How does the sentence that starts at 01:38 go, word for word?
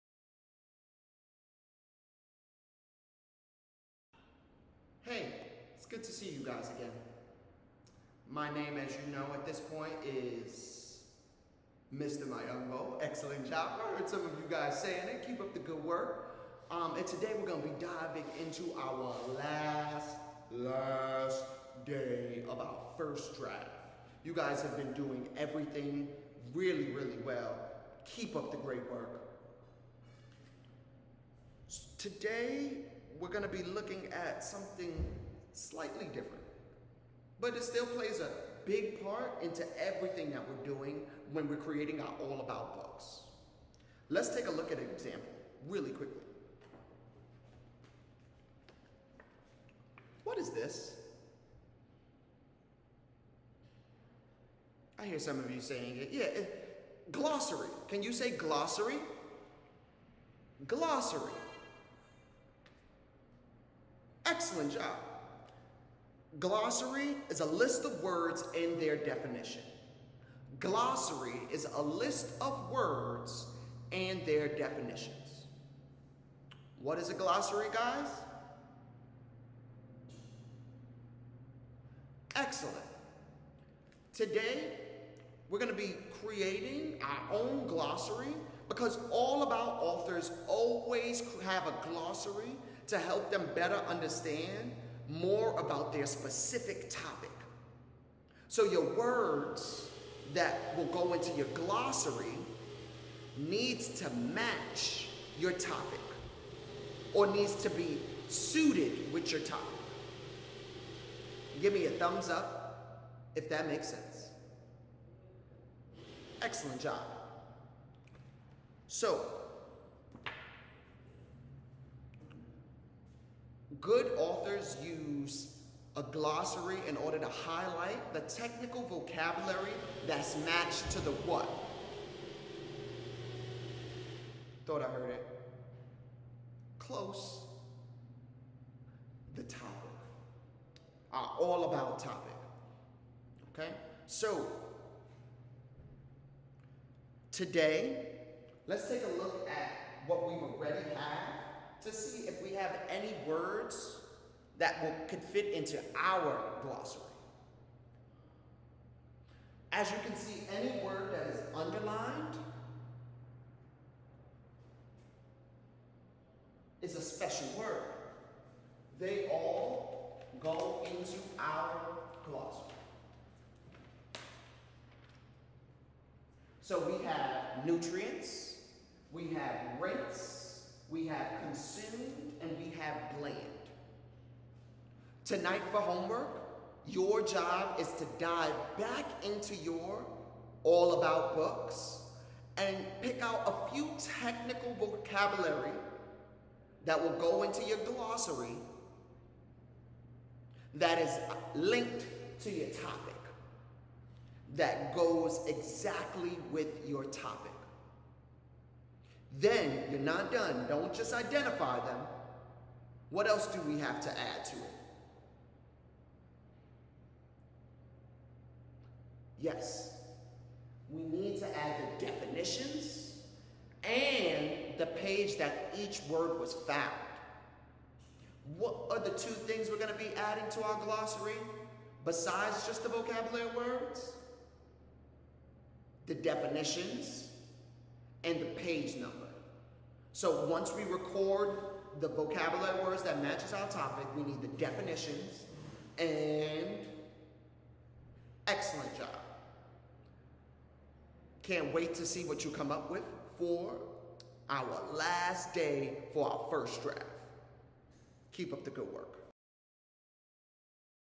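So your words that will go into your glossary needs to match your topic or needs to be suited with your topic.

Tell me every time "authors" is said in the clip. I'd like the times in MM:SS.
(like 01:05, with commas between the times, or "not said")
01:29, 02:04.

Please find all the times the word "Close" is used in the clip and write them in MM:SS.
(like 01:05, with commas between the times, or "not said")
02:16.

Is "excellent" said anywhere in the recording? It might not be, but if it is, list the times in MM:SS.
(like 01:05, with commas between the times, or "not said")
00:13, 01:04, 01:22, 01:56, 04:08.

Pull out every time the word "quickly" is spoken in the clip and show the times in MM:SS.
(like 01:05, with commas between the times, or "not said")
00:45.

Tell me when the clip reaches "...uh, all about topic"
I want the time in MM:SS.
02:21.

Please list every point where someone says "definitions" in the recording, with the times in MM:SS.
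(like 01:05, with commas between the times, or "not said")
01:08, 01:14, 03:42, 03:56, 04:04.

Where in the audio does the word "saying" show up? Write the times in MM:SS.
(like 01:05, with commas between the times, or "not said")
00:14, 00:55.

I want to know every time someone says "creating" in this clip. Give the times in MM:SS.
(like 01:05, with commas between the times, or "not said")
00:41, 01:26.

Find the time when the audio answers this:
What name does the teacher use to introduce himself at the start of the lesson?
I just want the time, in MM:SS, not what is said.
00:11.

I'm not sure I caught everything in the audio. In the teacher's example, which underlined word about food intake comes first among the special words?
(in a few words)
nutrients.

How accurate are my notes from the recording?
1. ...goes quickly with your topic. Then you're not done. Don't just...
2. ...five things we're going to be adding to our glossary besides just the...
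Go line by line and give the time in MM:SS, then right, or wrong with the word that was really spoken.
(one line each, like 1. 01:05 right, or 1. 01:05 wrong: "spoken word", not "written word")
1. 03:24 wrong: "exactly", not "quickly"
2. 03:49 wrong: "two", not "five".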